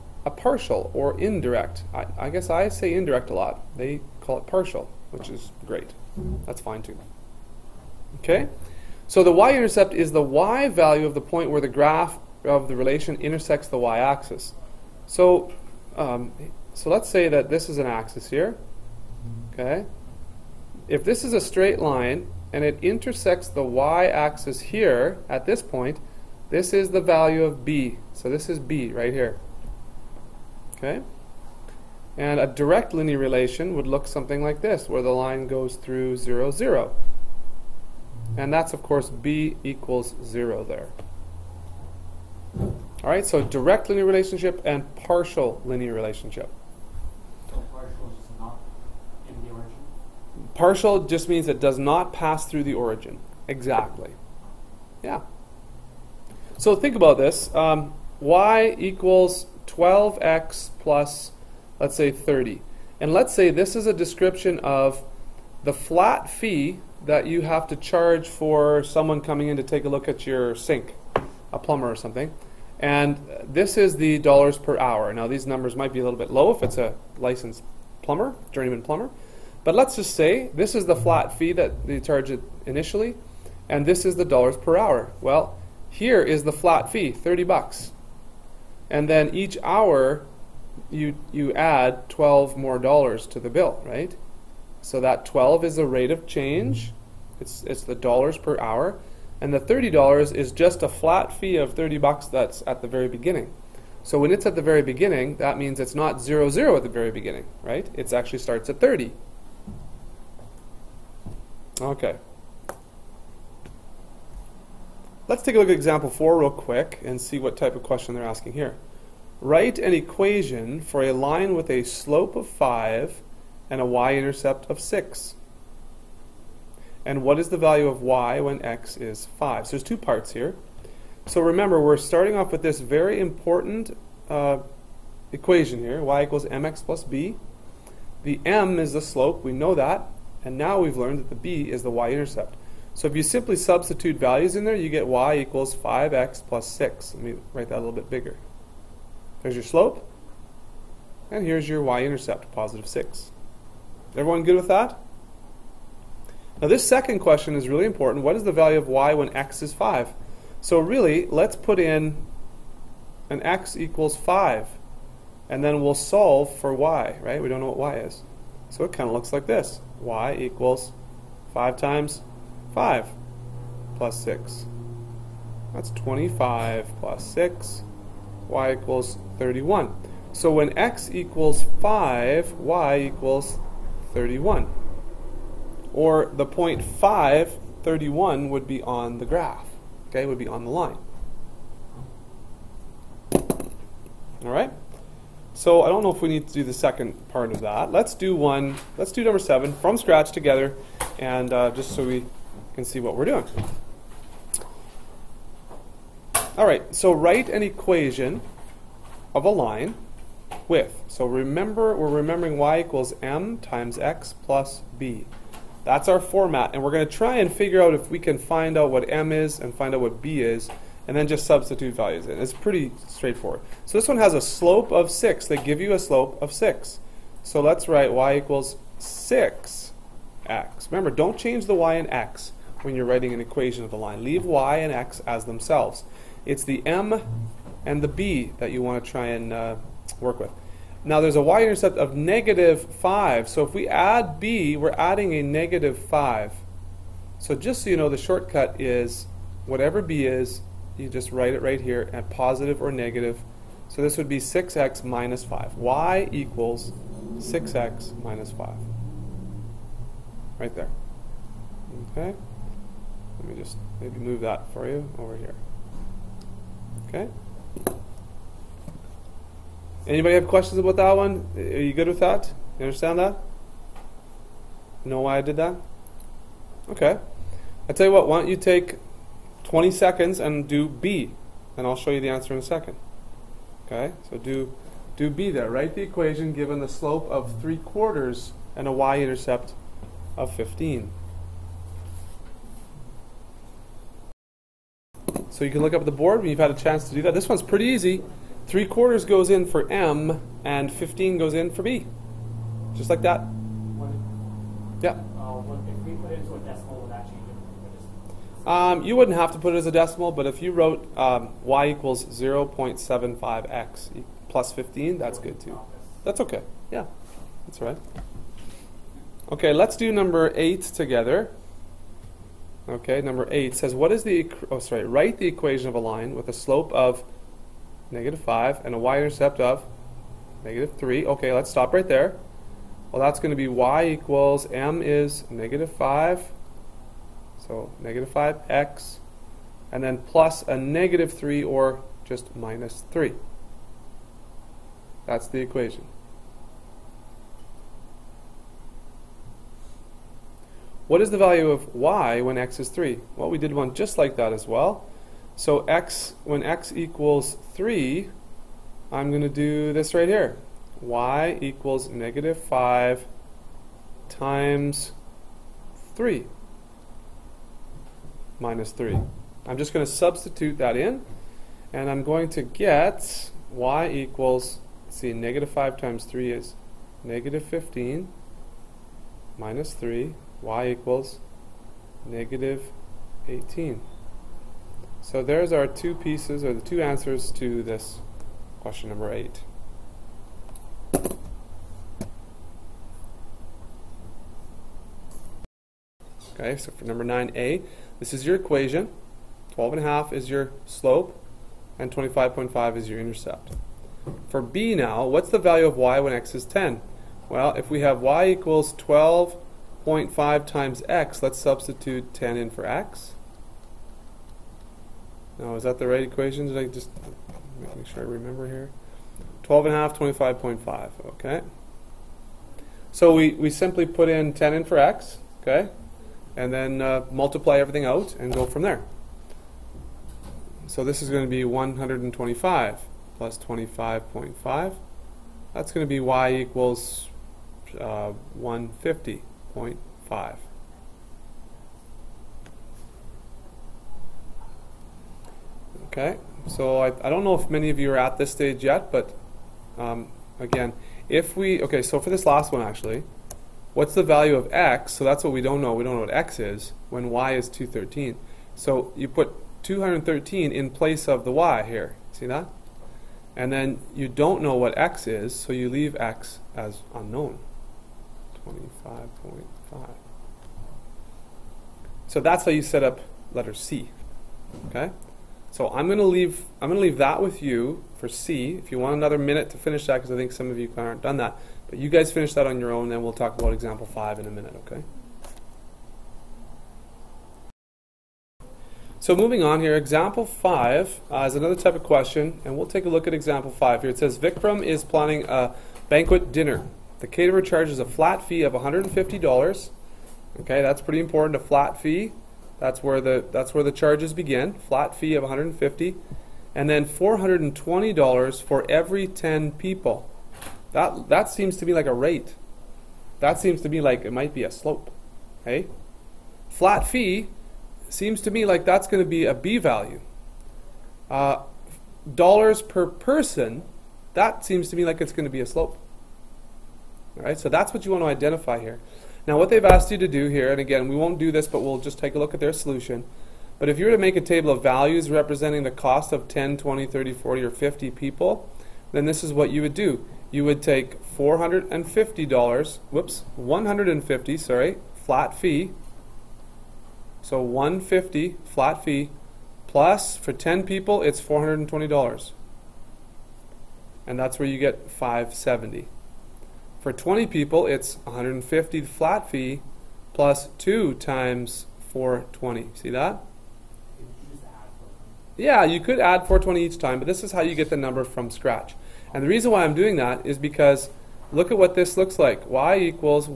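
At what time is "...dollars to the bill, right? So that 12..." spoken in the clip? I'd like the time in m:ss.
1:32.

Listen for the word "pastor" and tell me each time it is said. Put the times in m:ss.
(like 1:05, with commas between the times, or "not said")
not said.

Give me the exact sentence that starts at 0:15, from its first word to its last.
So um, so let's say that this is an axis here.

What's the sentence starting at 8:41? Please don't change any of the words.
Uh, dollars per person, that seems to me like it's going to be a slope.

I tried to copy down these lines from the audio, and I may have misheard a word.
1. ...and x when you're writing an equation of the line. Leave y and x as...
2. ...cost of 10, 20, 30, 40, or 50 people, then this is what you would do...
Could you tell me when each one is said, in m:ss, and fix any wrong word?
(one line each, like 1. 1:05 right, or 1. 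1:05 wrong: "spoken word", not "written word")
1. 3:51 right
2. 8:55 right.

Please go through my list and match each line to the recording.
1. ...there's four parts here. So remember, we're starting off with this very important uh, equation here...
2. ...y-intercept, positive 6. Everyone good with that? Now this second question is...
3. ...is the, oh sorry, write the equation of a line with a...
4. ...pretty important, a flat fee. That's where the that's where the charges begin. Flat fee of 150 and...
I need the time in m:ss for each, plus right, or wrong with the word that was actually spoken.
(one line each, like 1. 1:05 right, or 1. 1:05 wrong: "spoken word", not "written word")
1. 2:09 wrong: "two", not "four"
2. 2:31 right
3. 5:24 right
4. 8:21 right.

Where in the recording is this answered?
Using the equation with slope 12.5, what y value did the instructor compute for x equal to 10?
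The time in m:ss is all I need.
7:18.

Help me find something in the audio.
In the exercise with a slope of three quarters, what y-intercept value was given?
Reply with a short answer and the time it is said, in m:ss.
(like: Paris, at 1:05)
15, at 4:48.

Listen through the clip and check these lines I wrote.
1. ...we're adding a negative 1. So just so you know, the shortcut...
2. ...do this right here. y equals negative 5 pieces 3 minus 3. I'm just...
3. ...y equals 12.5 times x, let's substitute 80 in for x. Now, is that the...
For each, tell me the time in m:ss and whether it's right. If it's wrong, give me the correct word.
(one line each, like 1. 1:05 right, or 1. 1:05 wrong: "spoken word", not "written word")
1. 4:04 wrong: "5", not "1"
2. 5:59 wrong: "times", not "pieces"
3. 6:48 wrong: "10", not "80".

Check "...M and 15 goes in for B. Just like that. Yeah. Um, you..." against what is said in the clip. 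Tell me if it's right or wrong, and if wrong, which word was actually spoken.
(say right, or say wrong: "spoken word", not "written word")
right.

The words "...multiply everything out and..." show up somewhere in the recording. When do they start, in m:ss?
7:07.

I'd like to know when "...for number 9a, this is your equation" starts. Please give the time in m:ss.
6:36.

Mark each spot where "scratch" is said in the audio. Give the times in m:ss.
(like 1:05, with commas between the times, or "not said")
3:19, 9:28.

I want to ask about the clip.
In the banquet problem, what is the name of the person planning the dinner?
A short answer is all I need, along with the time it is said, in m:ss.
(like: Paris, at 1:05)
Vikram, at 8:14.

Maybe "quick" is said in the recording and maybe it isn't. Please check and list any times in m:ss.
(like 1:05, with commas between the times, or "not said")
1:56.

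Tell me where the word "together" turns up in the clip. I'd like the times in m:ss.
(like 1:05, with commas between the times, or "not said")
3:20, 5:20.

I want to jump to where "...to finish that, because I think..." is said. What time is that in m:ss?
7:59.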